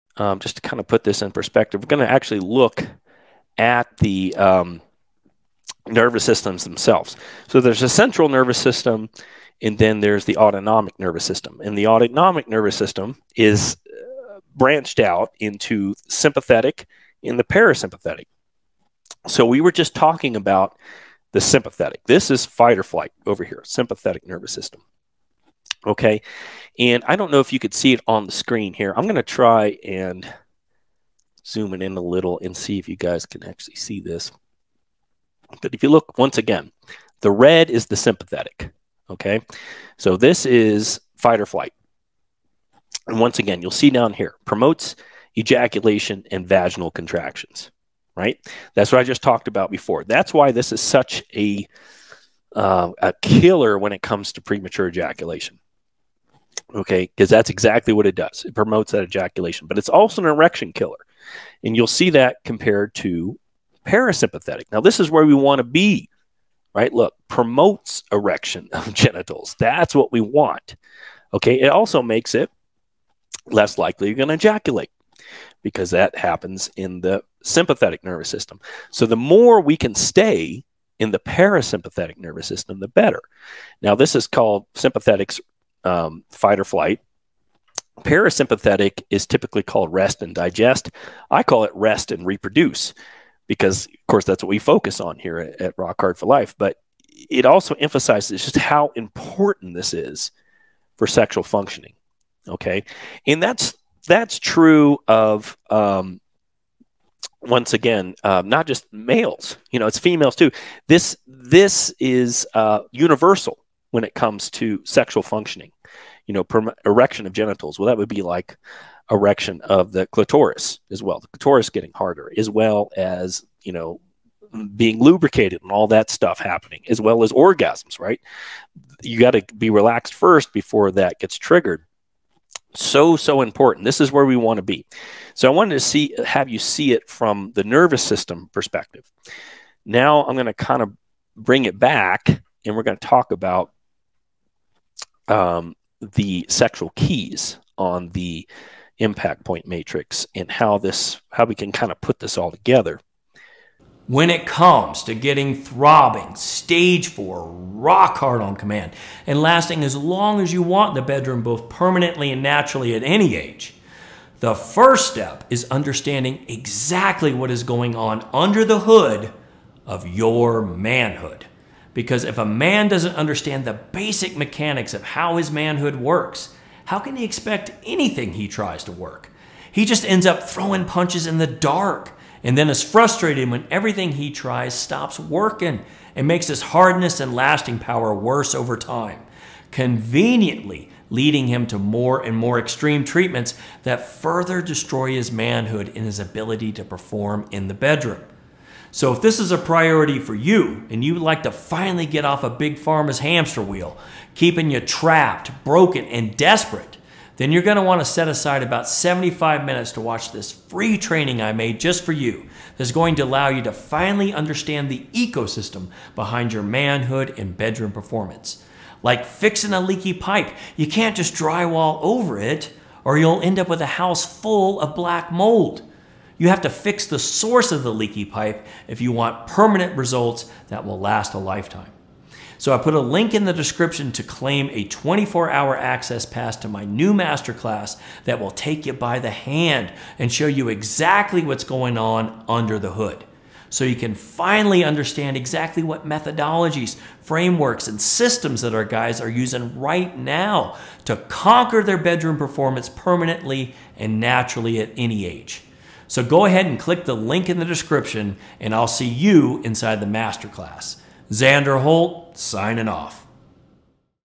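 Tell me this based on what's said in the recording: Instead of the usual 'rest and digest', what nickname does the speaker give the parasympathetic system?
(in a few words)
rest and reproduce.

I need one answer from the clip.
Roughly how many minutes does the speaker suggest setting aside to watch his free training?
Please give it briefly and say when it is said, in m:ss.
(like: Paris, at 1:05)
75 minutes, at 3:28.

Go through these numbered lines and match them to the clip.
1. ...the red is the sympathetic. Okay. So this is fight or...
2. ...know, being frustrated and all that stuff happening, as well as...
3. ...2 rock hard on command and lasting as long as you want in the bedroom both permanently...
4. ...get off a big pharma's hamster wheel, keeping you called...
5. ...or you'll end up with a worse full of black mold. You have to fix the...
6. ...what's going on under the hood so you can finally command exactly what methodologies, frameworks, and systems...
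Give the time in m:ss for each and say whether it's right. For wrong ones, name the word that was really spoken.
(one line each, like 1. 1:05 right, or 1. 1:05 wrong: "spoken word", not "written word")
1. 0:37 right
2. 2:03 wrong: "lubricated", not "frustrated"
3. 2:37 wrong: "4", not "2"
4. 3:22 wrong: "trapped", not "called"
5. 3:43 wrong: "house", not "worse"
6. 4:01 wrong: "understand", not "command".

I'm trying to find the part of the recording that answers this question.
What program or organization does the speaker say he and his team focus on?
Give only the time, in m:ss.
1:35.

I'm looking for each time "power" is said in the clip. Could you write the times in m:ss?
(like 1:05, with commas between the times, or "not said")
3:07.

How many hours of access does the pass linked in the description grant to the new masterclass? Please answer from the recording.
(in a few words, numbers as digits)
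24.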